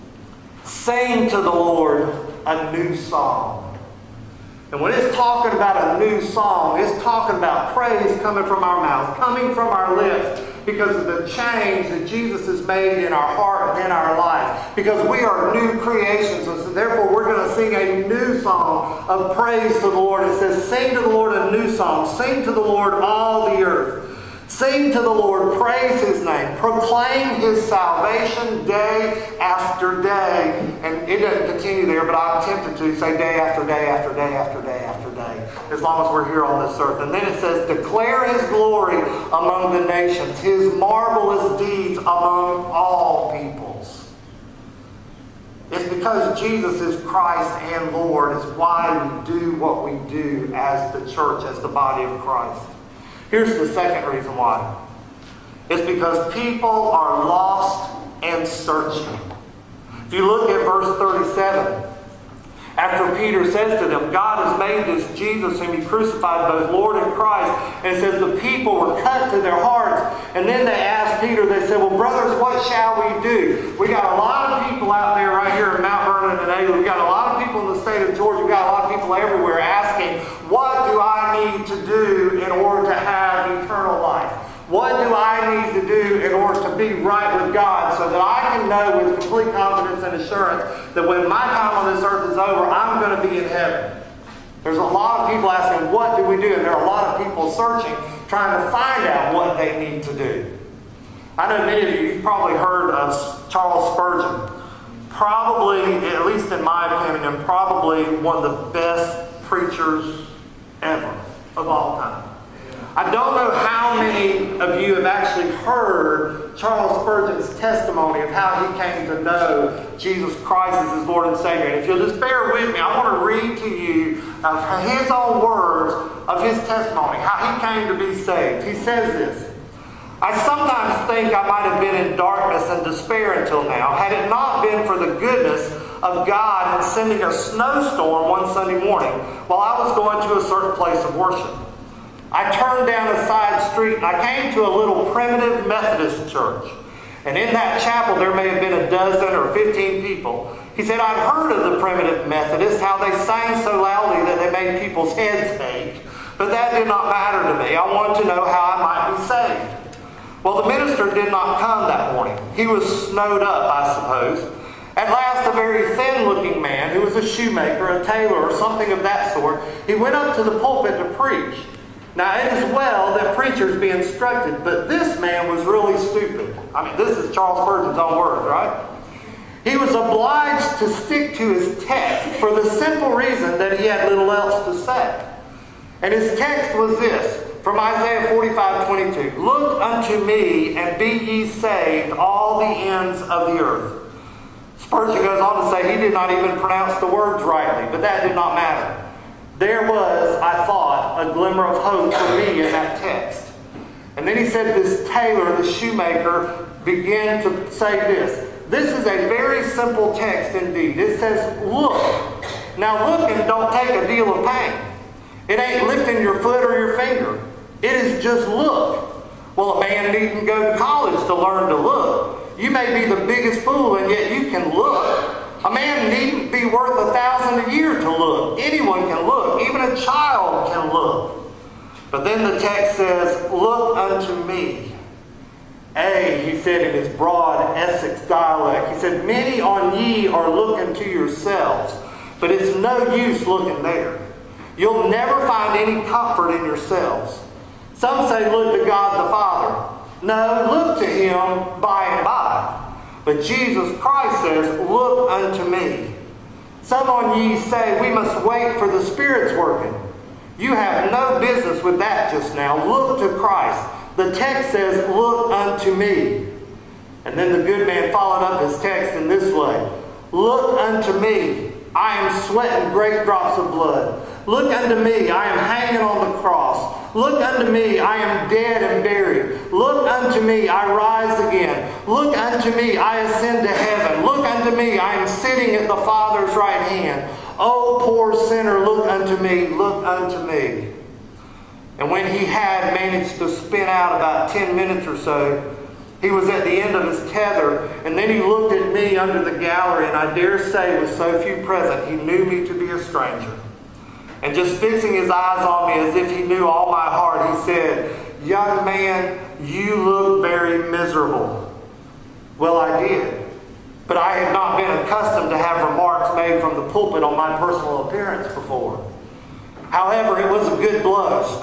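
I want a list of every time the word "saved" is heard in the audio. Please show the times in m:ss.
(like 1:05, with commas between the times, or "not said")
2:08, 2:39, 3:11.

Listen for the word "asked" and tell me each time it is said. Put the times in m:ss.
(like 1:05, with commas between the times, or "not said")
1:10.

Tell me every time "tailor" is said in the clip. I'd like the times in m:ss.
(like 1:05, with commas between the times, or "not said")
2:48, 3:25.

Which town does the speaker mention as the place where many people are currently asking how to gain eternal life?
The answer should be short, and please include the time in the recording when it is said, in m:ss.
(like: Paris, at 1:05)
Mount Vernon, at 1:15.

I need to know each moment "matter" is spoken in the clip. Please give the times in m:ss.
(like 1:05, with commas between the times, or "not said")
2:37, 3:18.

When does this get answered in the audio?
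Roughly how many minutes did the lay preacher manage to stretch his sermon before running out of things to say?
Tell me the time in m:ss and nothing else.
4:54.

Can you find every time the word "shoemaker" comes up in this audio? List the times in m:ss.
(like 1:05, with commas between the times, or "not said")
2:47, 3:25.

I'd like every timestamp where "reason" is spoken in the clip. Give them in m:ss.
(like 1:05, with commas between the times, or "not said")
0:54, 3:03.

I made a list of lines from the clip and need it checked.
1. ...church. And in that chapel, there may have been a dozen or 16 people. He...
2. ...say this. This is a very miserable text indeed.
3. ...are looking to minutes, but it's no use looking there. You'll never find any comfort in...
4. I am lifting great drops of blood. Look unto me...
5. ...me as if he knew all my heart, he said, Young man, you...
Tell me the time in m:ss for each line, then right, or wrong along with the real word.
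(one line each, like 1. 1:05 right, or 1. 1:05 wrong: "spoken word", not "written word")
1. 2:26 wrong: "15", not "16"
2. 3:27 wrong: "simple", not "miserable"
3. 4:00 wrong: "yourselves", not "minutes"
4. 4:31 wrong: "sweating", not "lifting"
5. 5:05 right.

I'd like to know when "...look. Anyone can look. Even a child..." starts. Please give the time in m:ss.
3:48.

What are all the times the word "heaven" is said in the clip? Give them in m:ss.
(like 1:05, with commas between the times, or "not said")
1:33, 4:43.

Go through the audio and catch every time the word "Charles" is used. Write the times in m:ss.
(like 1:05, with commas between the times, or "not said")
1:43, 1:56, 2:57.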